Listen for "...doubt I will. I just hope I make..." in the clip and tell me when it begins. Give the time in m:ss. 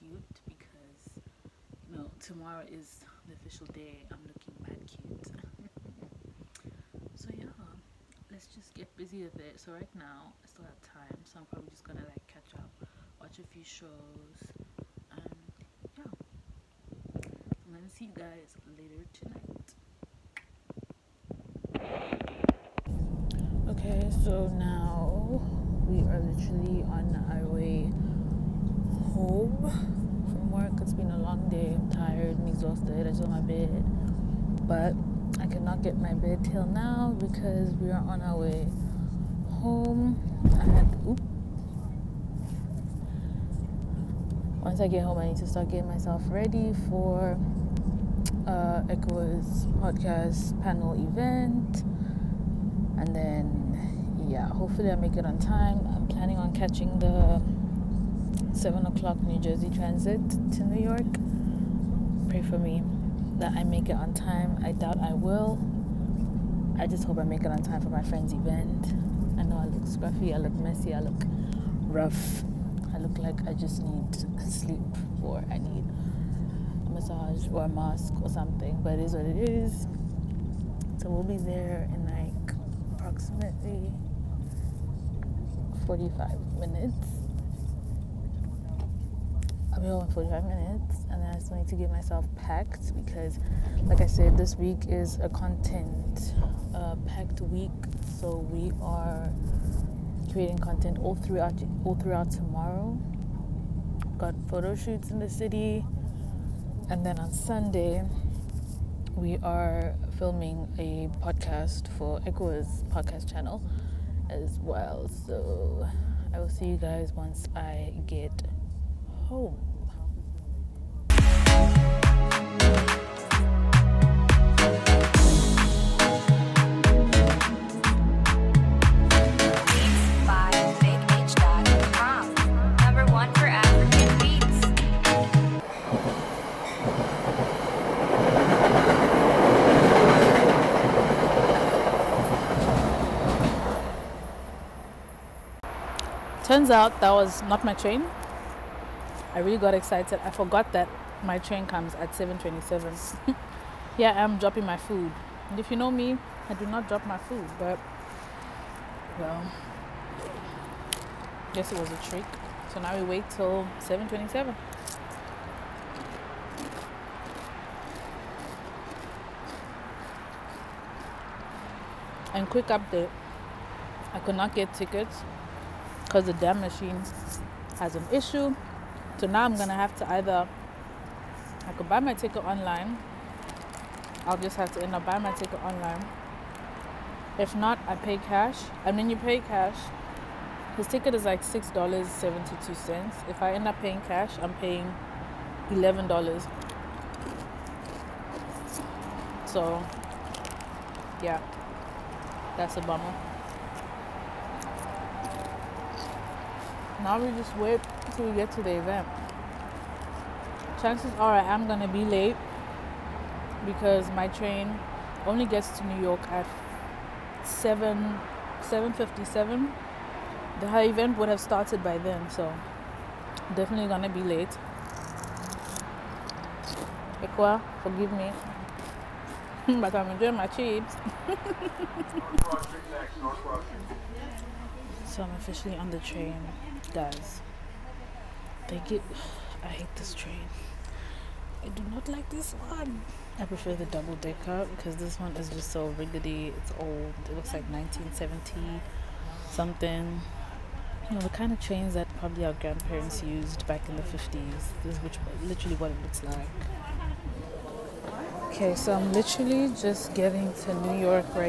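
1:04.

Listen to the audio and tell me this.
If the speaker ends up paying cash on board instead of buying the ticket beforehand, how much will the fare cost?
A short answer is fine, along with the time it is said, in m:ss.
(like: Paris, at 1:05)
$11, at 3:15.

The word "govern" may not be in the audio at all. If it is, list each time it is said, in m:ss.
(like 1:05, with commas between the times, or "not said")
not said.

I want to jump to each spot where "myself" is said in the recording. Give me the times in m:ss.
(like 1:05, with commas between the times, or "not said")
0:45, 1:31.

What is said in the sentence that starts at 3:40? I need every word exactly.
The event would have started by then, so definitely gonna be late.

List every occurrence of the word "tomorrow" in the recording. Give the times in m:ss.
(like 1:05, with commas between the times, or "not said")
0:02, 1:42.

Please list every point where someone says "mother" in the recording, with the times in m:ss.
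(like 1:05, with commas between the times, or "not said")
not said.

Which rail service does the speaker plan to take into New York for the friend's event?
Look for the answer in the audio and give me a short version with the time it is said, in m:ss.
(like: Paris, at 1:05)
New Jersey Transit, at 0:59.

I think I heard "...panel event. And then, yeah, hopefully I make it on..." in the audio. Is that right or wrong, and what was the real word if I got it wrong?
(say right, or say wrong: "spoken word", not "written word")
right.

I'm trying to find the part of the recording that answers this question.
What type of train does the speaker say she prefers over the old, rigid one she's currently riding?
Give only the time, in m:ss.
4:03.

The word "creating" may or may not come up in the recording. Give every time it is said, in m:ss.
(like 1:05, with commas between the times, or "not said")
1:40.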